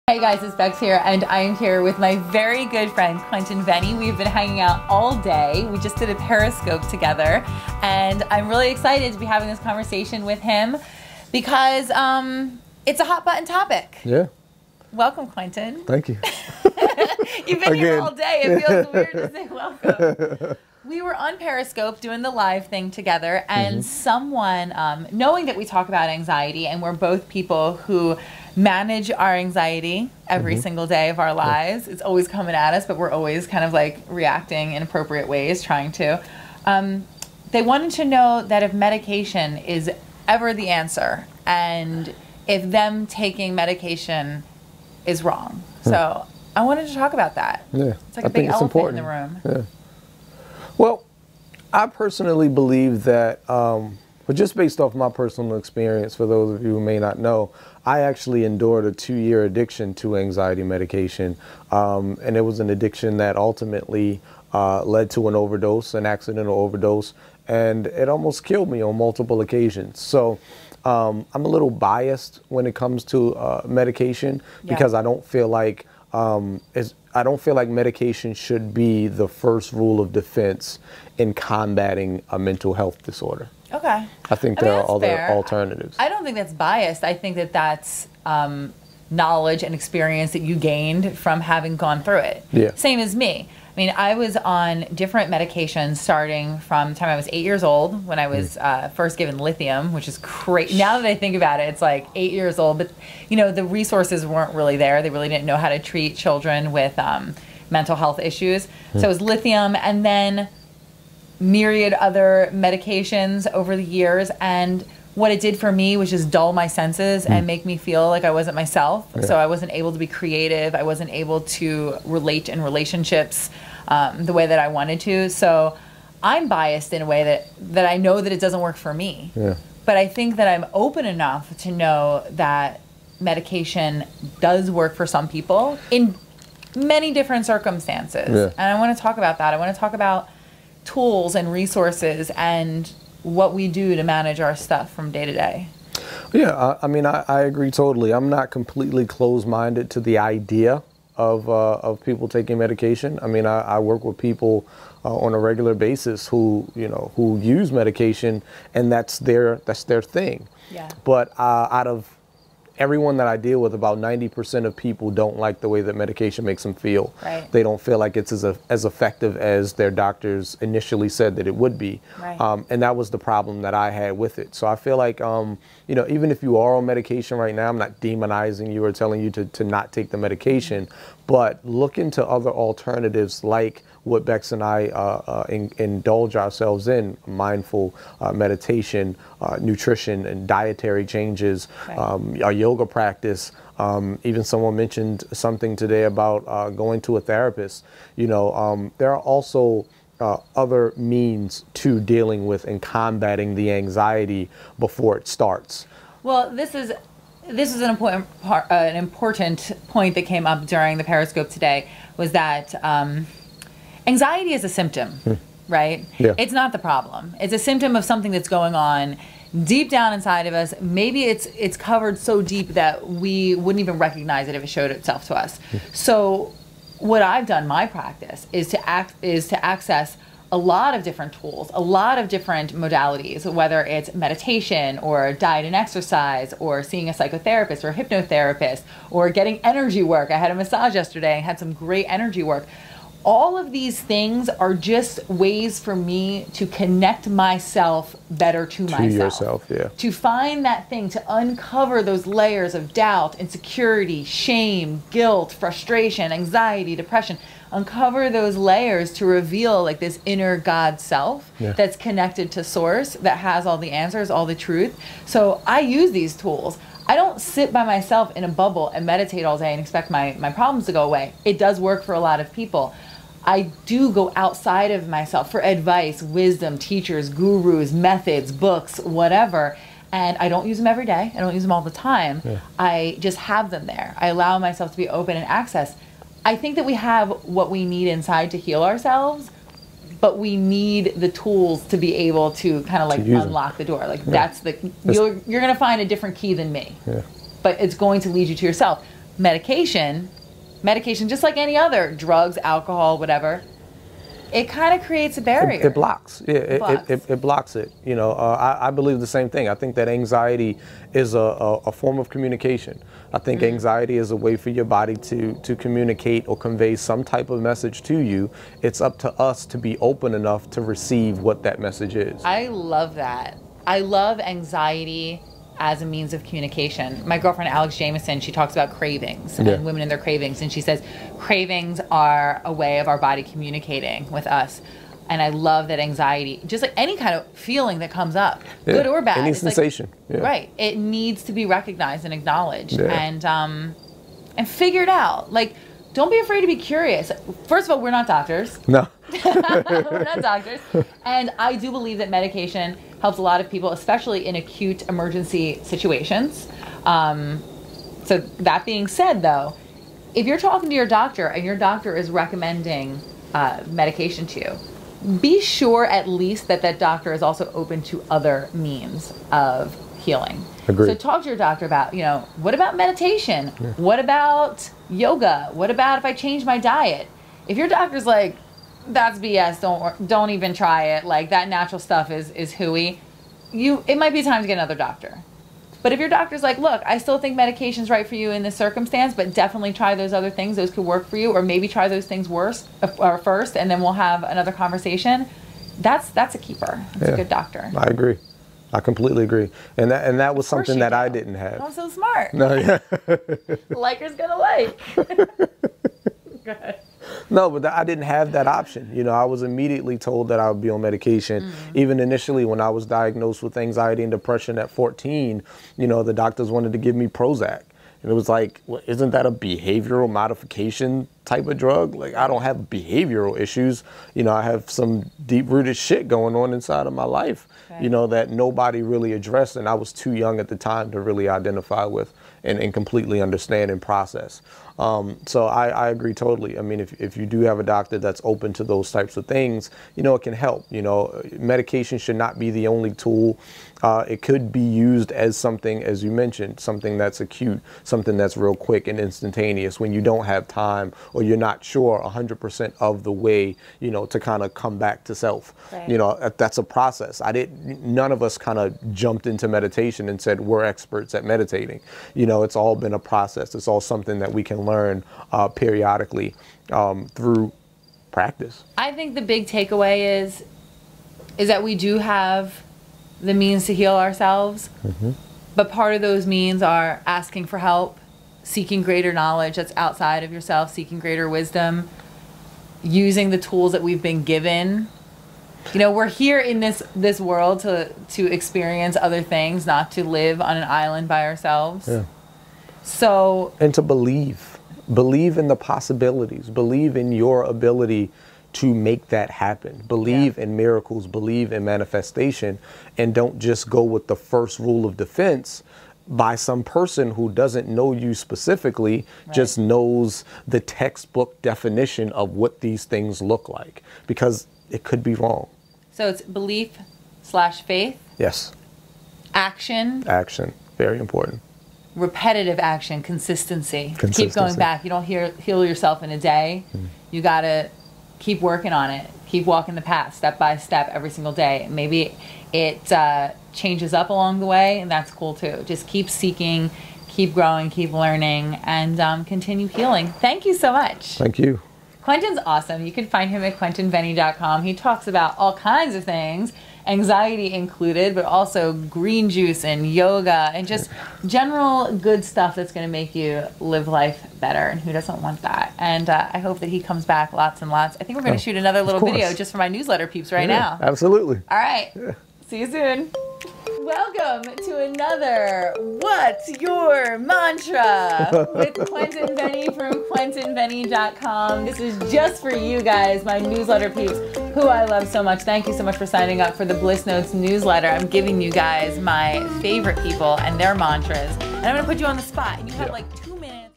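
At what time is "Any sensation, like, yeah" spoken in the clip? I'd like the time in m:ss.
5:39.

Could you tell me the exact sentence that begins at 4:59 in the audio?
Medication medication, just like any other drugs, alcohol, whatever.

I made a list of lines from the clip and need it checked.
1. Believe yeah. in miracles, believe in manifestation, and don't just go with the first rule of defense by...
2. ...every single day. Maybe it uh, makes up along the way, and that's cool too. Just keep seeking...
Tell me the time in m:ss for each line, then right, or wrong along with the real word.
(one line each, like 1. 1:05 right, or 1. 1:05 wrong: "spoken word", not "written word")
1. 8:20 right
2. 8:51 wrong: "changes", not "makes".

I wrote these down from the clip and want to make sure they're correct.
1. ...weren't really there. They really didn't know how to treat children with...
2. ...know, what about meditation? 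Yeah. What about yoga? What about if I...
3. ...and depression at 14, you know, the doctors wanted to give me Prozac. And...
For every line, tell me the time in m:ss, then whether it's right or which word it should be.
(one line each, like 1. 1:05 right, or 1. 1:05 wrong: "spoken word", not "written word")
1. 1:44 right
2. 6:12 right
3. 6:54 right.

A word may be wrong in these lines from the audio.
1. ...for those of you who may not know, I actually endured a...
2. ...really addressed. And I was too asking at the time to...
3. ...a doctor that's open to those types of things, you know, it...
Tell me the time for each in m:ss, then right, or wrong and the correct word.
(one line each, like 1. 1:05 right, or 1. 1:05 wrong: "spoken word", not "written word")
1. 0:56 right
2. 7:09 wrong: "young", not "asking"
3. 7:17 right.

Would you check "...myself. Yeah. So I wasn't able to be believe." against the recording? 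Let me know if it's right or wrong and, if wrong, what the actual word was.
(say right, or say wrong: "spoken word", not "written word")
wrong: "creative", not "believe".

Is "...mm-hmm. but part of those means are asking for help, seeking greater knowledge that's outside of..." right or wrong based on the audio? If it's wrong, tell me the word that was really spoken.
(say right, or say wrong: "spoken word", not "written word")
right.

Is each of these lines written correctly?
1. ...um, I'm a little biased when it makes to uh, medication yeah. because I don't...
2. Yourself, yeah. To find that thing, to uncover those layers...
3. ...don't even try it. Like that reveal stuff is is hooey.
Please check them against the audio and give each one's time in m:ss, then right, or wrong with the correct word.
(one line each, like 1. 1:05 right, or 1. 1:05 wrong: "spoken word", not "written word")
1. 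1:10 wrong: "comes", not "makes"
2. 4:09 right
3. 6:20 wrong: "natural", not "reveal".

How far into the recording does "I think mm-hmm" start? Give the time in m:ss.
5:13.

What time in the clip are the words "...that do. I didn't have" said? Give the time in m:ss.
6:40.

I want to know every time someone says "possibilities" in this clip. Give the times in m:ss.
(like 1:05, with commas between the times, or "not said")
8:15.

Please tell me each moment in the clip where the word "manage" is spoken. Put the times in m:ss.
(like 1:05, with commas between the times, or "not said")
0:28, 2:24.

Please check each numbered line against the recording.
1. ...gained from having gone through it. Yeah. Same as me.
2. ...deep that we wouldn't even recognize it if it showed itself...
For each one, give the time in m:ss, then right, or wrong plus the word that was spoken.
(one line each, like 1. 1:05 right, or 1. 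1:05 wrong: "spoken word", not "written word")
1. 1:30 right
2. 3:42 right.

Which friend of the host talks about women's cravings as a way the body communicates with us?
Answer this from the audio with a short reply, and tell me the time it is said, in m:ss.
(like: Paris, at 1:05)
Alex Jamieson, at 5:27.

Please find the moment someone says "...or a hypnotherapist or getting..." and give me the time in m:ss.
3:57.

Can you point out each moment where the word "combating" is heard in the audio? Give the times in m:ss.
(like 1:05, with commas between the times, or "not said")
1:21, 3:22.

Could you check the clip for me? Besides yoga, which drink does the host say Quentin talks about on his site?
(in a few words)
Green juice.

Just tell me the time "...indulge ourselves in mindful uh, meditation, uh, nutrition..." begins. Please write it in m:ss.
3:05.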